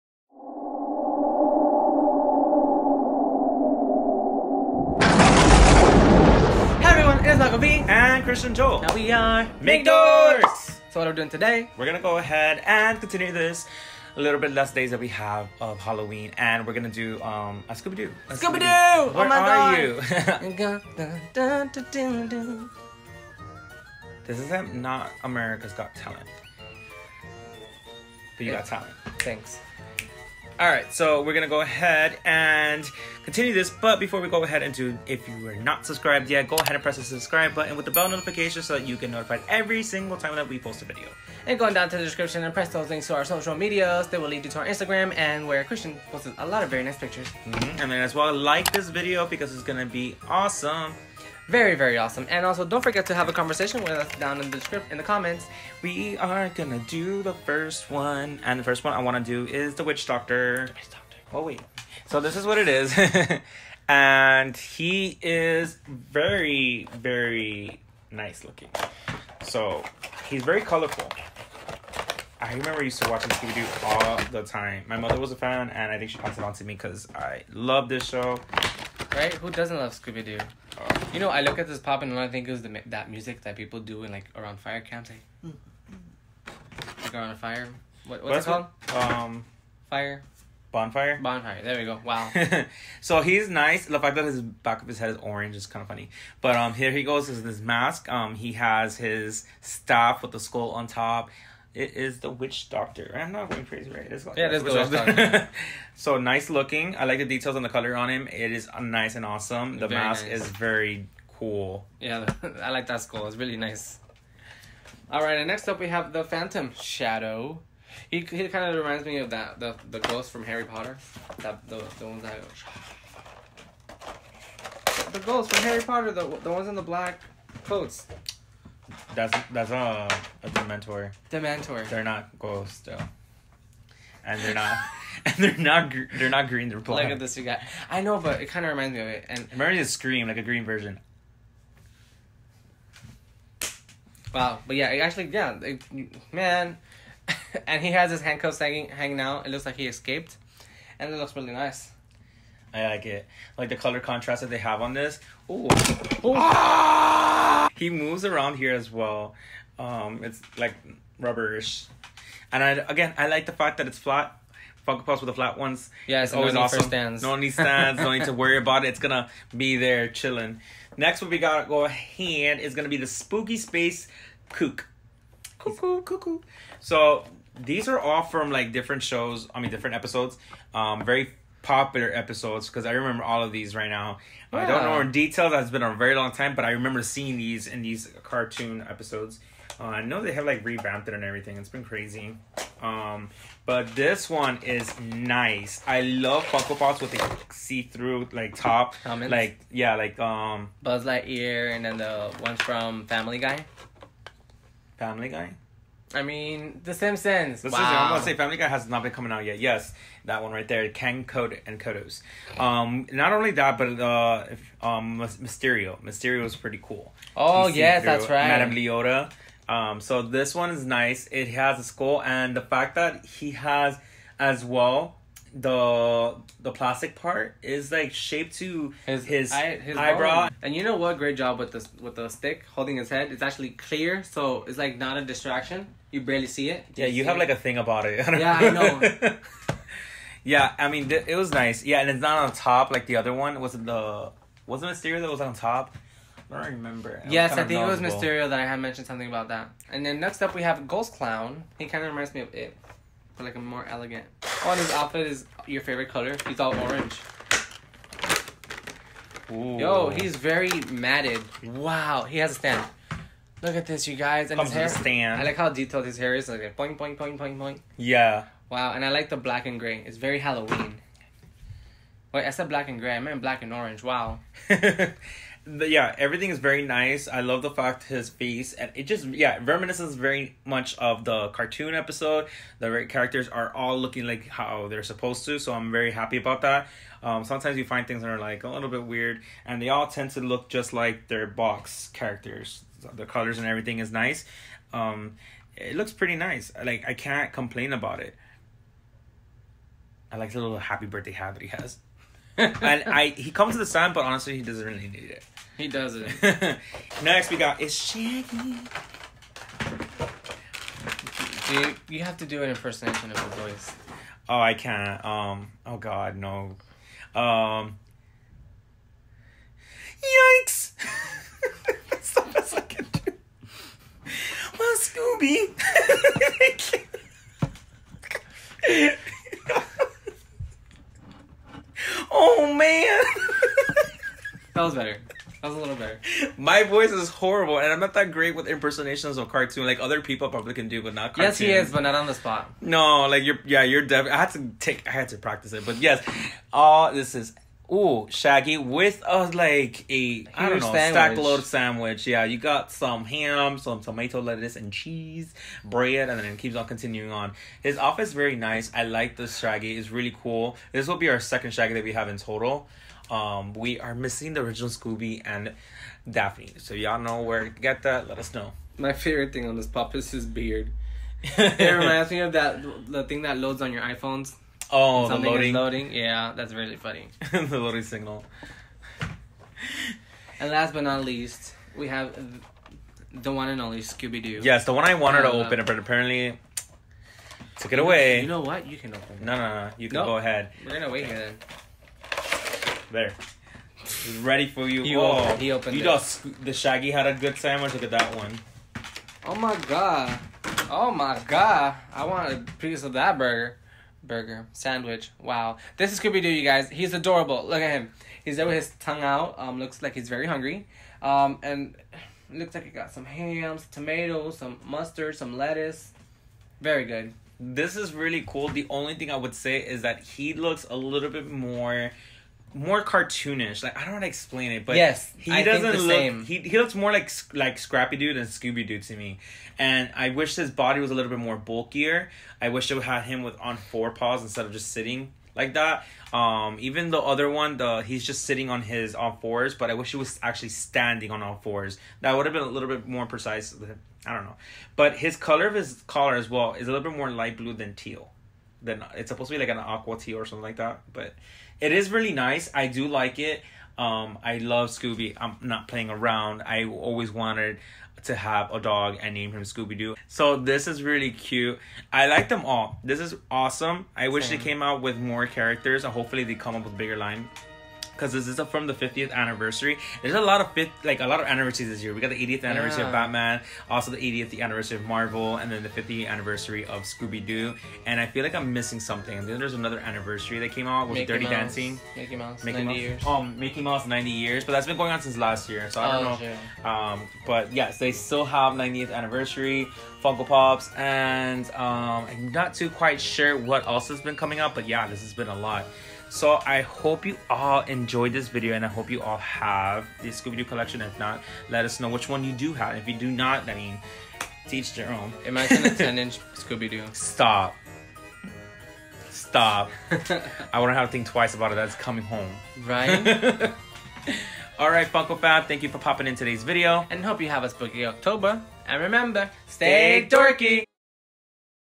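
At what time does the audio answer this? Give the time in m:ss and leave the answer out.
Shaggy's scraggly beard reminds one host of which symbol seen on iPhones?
6:17.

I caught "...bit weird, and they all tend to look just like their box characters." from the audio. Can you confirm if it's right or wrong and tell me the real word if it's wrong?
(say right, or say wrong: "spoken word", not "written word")
right.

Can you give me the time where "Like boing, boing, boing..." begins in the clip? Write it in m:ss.
4:26.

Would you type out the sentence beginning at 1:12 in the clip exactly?
I remember used to watching Scooby Doo all the time.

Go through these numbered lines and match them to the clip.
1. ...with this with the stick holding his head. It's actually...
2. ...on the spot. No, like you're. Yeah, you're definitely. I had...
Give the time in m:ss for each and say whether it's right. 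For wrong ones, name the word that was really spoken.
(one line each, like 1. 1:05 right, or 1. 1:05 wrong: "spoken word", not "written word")
1. 3:51 right
2. 5:42 right.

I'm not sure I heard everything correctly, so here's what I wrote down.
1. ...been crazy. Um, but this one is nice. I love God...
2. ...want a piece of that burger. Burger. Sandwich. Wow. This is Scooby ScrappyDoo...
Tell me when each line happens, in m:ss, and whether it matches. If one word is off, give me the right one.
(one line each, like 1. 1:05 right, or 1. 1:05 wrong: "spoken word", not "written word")
1. 3:11 wrong: "Funko", not "God"
2. 6:42 wrong: "Doo", not "ScrappyDoo".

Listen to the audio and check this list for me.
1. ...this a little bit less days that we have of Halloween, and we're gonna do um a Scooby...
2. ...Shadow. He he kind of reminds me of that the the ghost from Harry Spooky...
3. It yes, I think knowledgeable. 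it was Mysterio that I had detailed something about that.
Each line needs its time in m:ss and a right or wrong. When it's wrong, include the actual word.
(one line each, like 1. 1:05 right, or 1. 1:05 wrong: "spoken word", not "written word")
1. 0:13 right
2. 1:56 wrong: "Potter", not "Spooky"
3. 4:07 wrong: "mentioned", not "detailed".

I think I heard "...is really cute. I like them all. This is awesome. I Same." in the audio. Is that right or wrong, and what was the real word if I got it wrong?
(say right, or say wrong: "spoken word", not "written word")
right.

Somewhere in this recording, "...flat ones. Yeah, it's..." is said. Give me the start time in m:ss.
2:45.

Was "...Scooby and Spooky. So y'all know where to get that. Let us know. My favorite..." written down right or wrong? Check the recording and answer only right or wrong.
wrong.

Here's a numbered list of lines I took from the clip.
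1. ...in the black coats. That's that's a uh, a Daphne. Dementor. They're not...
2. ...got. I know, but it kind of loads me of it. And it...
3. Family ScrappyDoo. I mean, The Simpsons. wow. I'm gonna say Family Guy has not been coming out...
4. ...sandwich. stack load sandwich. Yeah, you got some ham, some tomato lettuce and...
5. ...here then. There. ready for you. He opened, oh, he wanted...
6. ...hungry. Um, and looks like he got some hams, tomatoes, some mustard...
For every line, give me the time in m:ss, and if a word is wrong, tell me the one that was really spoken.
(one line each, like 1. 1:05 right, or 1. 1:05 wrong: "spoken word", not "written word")
1. 2:06 wrong: "Dementor", not "Daphne"
2. 2:17 wrong: "reminds", not "loads"
3. 3:25 wrong: "Guy", not "ScrappyDoo"
4. 5:50 right
5. 6:31 wrong: "opened", not "wanted"
6. 6:50 right.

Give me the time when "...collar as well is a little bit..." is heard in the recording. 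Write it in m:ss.
7:26.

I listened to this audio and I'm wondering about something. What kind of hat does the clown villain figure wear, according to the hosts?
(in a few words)
Happy birthday hat.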